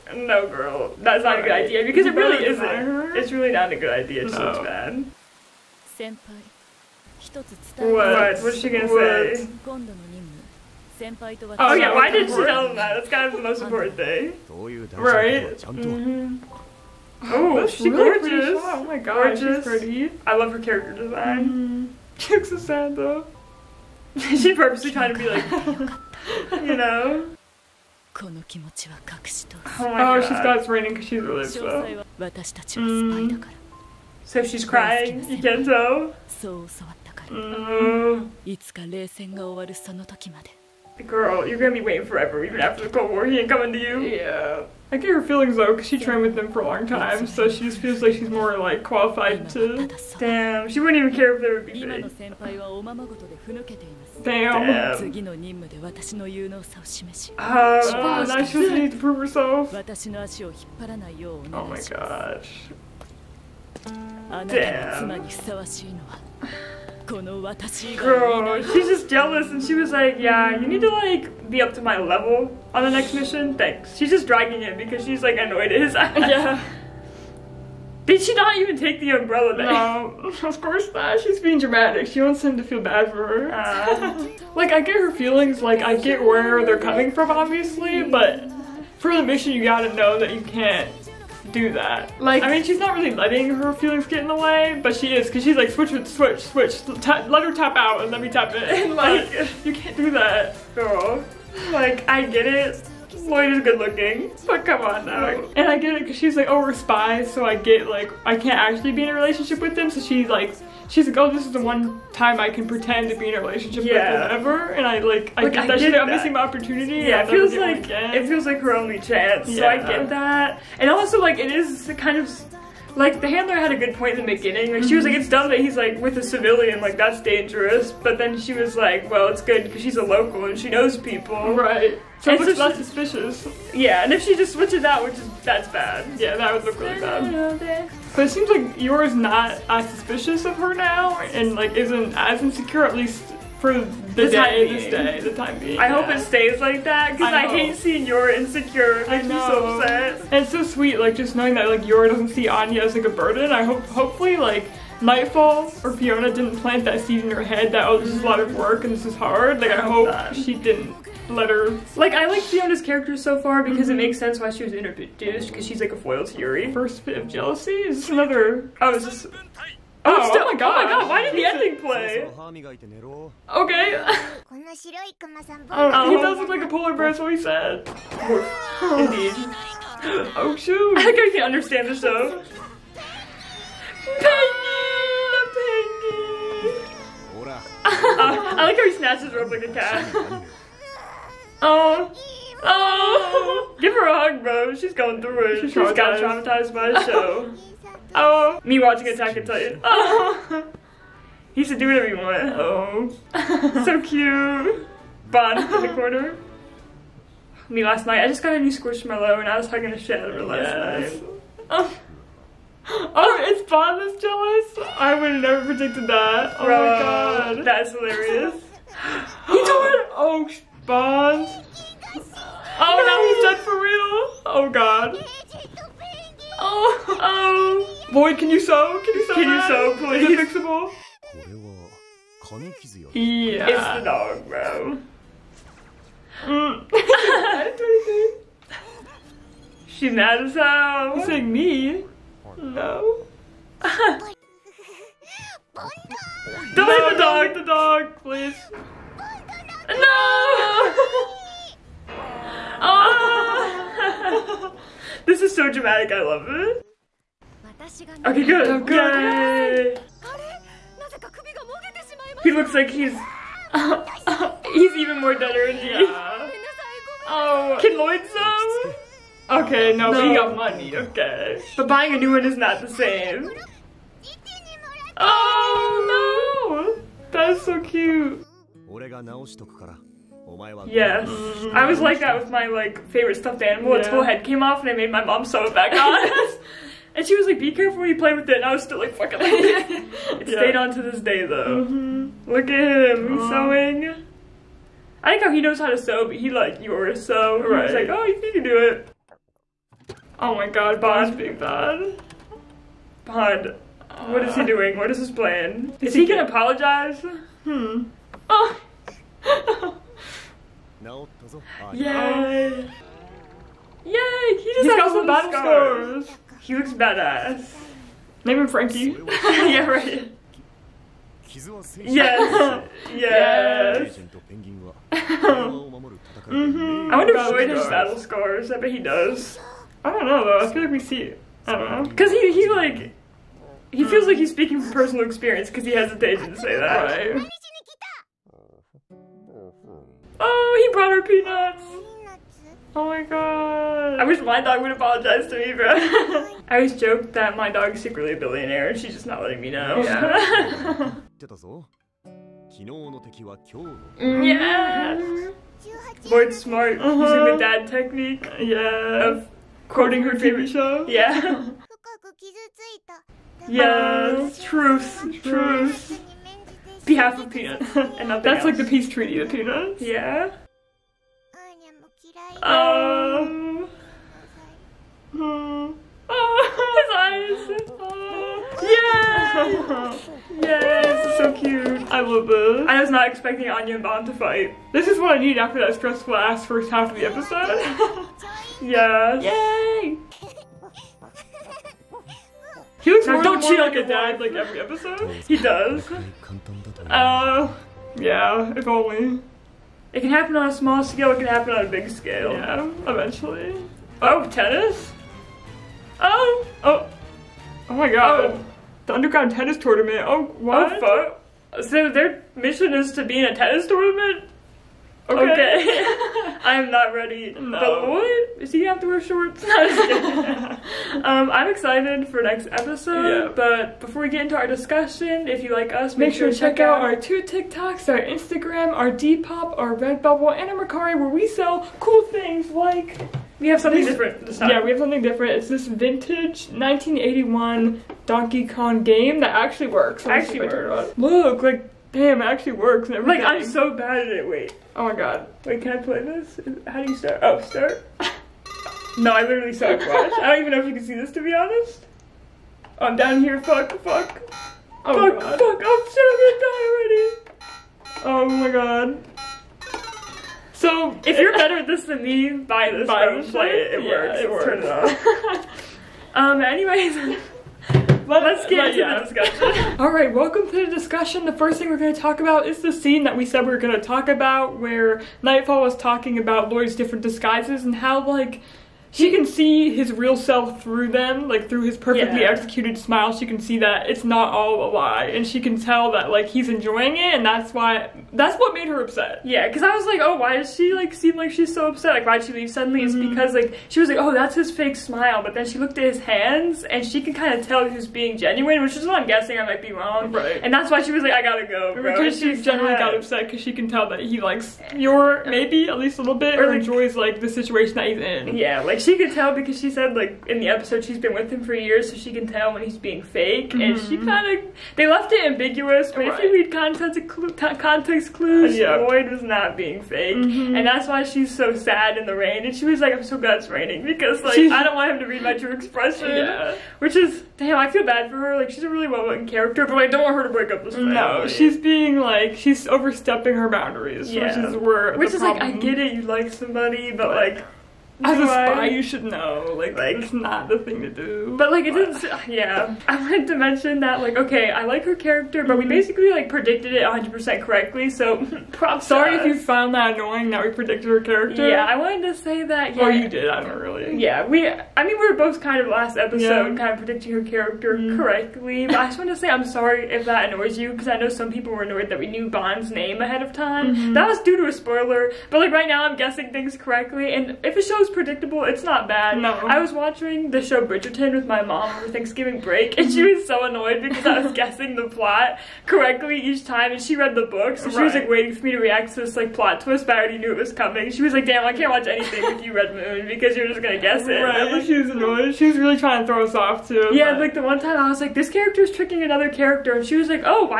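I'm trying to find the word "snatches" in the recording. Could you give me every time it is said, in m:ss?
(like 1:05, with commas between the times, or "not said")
3:08.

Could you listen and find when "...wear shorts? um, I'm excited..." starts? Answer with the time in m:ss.
6:59.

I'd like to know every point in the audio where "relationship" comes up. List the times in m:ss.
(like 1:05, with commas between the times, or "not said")
1:49, 1:53.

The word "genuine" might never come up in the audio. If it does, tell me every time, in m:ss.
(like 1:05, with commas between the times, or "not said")
8:18.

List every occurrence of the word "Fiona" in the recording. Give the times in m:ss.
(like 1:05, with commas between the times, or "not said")
2:35, 2:42.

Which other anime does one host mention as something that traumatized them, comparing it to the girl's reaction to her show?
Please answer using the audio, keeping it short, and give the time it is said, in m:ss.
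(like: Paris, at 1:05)
Attack on Titan, at 3:19.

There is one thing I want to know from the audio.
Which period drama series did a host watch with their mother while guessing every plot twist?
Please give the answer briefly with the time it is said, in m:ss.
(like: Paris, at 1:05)
Bridgerton, at 9:30.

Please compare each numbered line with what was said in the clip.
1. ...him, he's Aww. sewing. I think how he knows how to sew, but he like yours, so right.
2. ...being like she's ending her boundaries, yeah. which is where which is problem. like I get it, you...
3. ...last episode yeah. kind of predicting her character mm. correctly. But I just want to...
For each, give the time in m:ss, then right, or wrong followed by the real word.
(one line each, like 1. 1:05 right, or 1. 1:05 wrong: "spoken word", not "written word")
1. 4:53 right
2. 8:51 wrong: "overstepping", not "ending"
3. 9:15 right.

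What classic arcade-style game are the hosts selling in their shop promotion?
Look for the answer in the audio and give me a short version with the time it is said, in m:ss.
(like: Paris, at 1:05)
Donkey Kong, at 7:18.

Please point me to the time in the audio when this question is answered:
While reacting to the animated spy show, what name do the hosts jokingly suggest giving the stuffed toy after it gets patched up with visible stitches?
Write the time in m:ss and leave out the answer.
5:18.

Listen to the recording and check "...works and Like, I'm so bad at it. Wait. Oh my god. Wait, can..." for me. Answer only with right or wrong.
right.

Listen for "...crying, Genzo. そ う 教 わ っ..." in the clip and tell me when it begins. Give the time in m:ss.
0:34.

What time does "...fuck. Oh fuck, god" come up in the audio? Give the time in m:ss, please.
7:34.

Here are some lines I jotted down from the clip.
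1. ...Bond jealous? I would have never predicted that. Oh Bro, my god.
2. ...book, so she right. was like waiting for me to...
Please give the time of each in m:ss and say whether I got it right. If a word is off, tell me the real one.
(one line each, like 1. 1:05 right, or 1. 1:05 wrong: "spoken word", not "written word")
1. 3:33 right
2. 9:37 right.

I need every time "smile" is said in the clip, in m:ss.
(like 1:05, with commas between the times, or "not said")
8:02, 8:14.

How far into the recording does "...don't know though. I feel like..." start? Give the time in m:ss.
5:30.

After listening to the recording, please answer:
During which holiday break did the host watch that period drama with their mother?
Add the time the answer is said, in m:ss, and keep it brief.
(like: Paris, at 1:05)
Thanksgiving, at 9:32.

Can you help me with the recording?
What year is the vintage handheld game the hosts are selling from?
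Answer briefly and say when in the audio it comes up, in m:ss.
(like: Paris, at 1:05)
1981, at 7:16.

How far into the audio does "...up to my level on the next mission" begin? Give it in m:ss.
1:11.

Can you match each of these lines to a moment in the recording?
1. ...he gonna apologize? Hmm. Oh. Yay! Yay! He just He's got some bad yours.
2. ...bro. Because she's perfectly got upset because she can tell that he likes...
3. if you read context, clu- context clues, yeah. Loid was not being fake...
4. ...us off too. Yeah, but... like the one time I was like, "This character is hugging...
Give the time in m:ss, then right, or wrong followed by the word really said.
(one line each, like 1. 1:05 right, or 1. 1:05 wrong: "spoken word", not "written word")
1. 5:06 wrong: "scars", not "yours"
2. 8:21 wrong: "generally", not "perfectly"
3. 8:36 right
4. 9:46 wrong: "tricking", not "hugging".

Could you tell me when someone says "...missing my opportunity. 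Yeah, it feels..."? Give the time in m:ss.
1:56.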